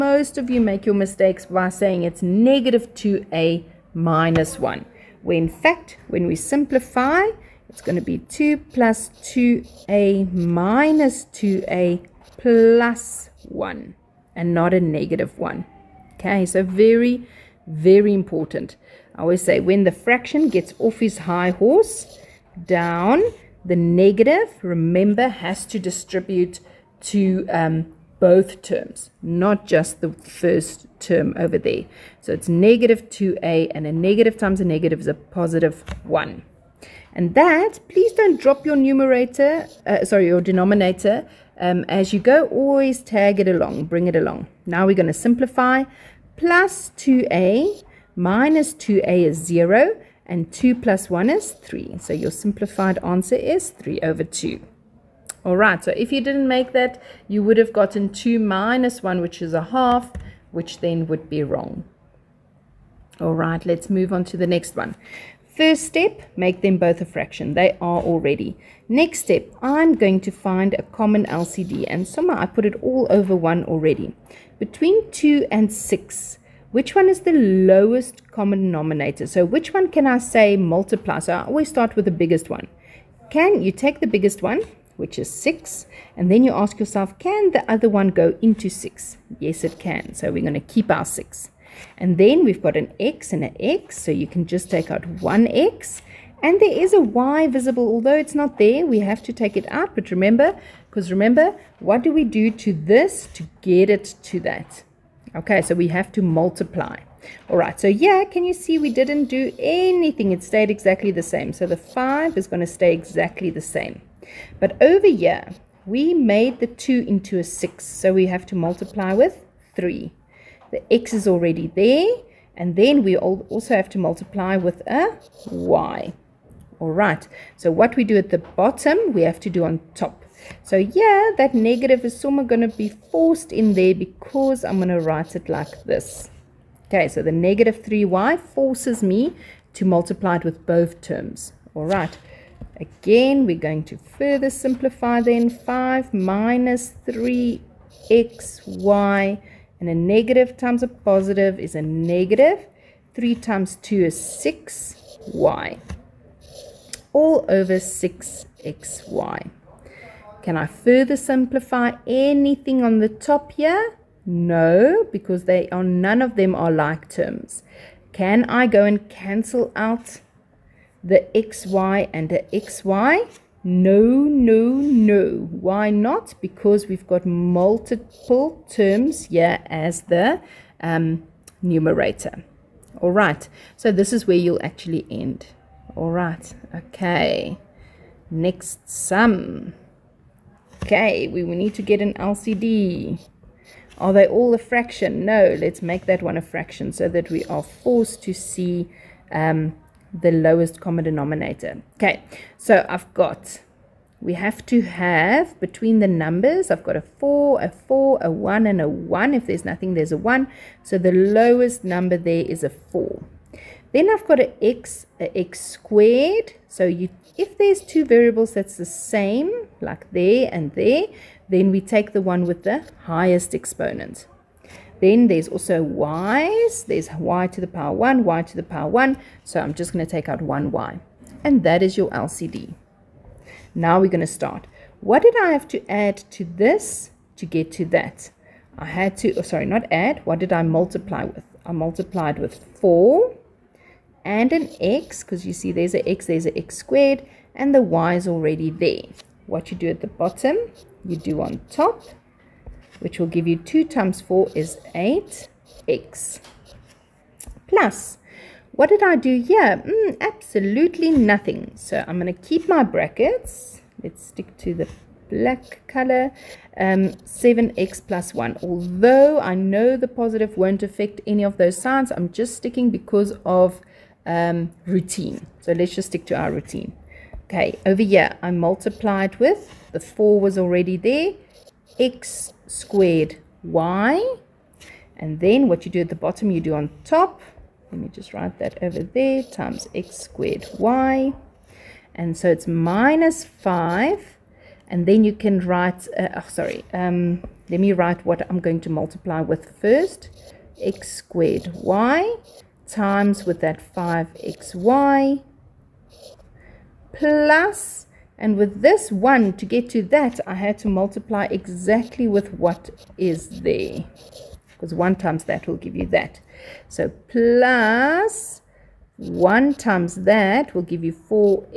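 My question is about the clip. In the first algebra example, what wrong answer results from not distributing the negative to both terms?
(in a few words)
a half.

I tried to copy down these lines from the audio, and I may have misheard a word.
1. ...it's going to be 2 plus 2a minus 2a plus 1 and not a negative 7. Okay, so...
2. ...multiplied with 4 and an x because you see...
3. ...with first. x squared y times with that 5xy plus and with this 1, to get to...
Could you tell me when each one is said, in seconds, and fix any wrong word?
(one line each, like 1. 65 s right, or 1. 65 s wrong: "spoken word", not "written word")
1. 7 s wrong: "1", not "7"
2. 241 s right
3. 299 s right.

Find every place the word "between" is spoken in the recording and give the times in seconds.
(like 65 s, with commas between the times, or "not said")
74 s, 205 s.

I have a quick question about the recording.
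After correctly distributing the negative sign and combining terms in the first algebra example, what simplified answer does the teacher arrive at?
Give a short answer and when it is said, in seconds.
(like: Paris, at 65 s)
3/2, at 53 s.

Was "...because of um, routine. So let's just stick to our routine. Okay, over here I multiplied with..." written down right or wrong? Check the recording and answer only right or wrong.
right.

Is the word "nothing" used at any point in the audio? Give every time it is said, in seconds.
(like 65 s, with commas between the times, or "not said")
209 s, 261 s.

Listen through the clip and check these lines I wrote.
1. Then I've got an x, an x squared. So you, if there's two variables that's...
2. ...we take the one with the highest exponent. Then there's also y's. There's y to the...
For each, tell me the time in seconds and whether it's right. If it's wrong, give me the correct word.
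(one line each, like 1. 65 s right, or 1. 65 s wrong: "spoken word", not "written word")
1. 213 s right
2. 221 s right.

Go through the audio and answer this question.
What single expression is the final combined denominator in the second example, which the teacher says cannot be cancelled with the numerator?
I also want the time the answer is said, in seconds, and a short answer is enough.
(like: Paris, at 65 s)
6xy, at 157 s.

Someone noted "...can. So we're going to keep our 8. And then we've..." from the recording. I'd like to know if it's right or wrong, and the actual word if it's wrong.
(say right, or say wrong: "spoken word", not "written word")
wrong: "6", not "8".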